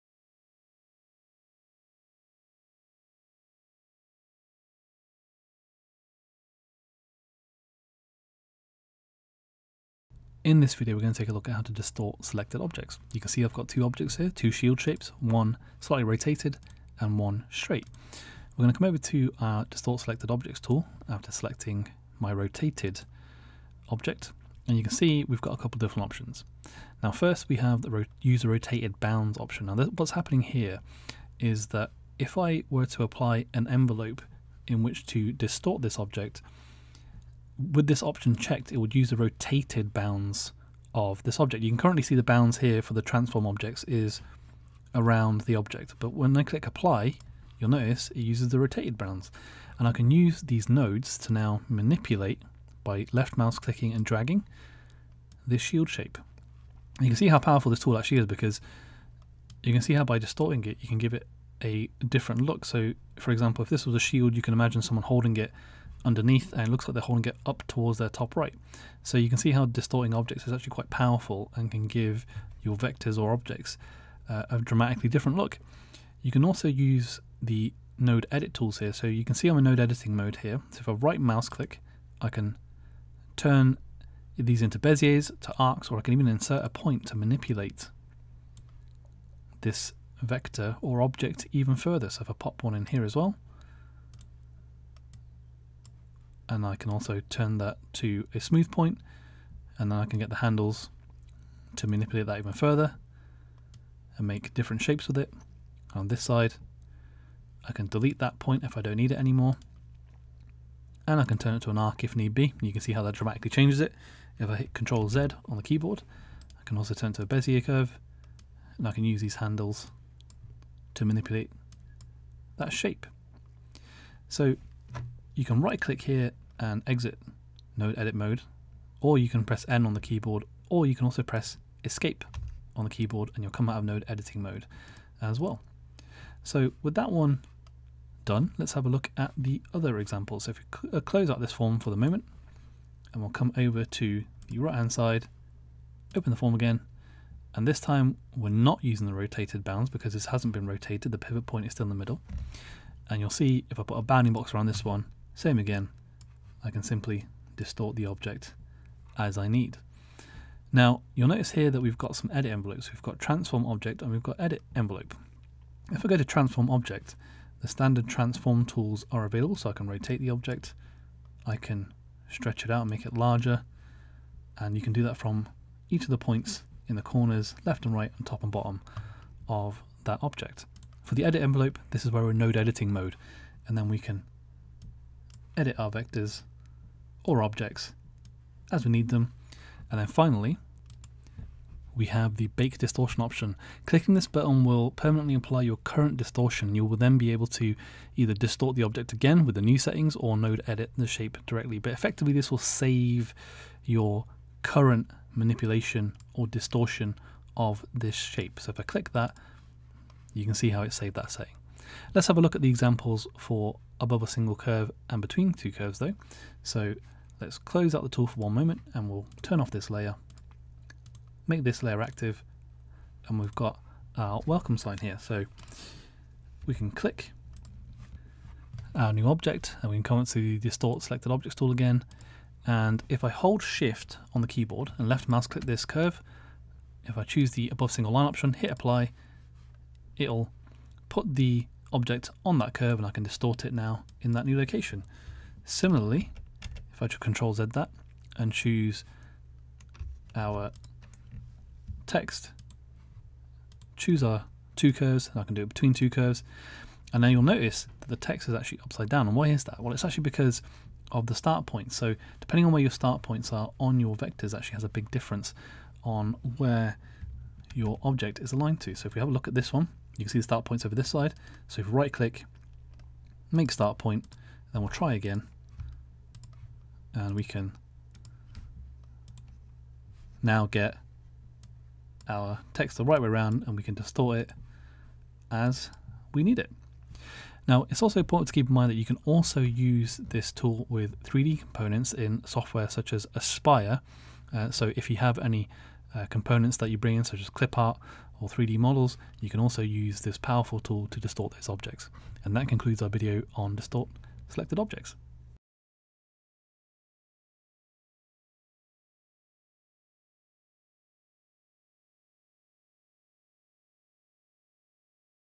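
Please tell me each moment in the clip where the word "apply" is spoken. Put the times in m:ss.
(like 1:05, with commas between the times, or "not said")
0:33, 0:46, 3:15, 3:58.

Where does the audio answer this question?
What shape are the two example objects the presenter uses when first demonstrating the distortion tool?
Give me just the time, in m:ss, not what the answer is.
0:14.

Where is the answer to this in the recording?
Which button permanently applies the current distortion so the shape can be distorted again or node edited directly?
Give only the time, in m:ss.
3:12.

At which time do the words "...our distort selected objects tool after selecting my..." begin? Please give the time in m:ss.
0:19.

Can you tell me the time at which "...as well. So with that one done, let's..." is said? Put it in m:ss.
2:15.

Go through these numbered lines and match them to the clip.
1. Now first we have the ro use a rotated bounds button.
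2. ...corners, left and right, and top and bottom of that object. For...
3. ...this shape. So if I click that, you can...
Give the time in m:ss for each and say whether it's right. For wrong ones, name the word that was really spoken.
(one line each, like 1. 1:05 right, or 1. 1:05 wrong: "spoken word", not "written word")
1. 0:27 wrong: "option", not "button"
2. 2:57 right
3. 3:27 right.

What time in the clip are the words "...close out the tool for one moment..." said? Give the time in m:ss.
3:37.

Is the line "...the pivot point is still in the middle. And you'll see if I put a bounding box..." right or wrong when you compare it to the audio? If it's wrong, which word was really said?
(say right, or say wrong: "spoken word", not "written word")
right.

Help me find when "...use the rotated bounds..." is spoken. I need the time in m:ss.
0:38.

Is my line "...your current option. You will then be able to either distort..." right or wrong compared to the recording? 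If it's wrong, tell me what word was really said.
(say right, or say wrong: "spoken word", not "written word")
wrong: "distortion", not "option".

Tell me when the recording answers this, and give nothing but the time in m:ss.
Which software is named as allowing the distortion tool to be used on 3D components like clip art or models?
4:53.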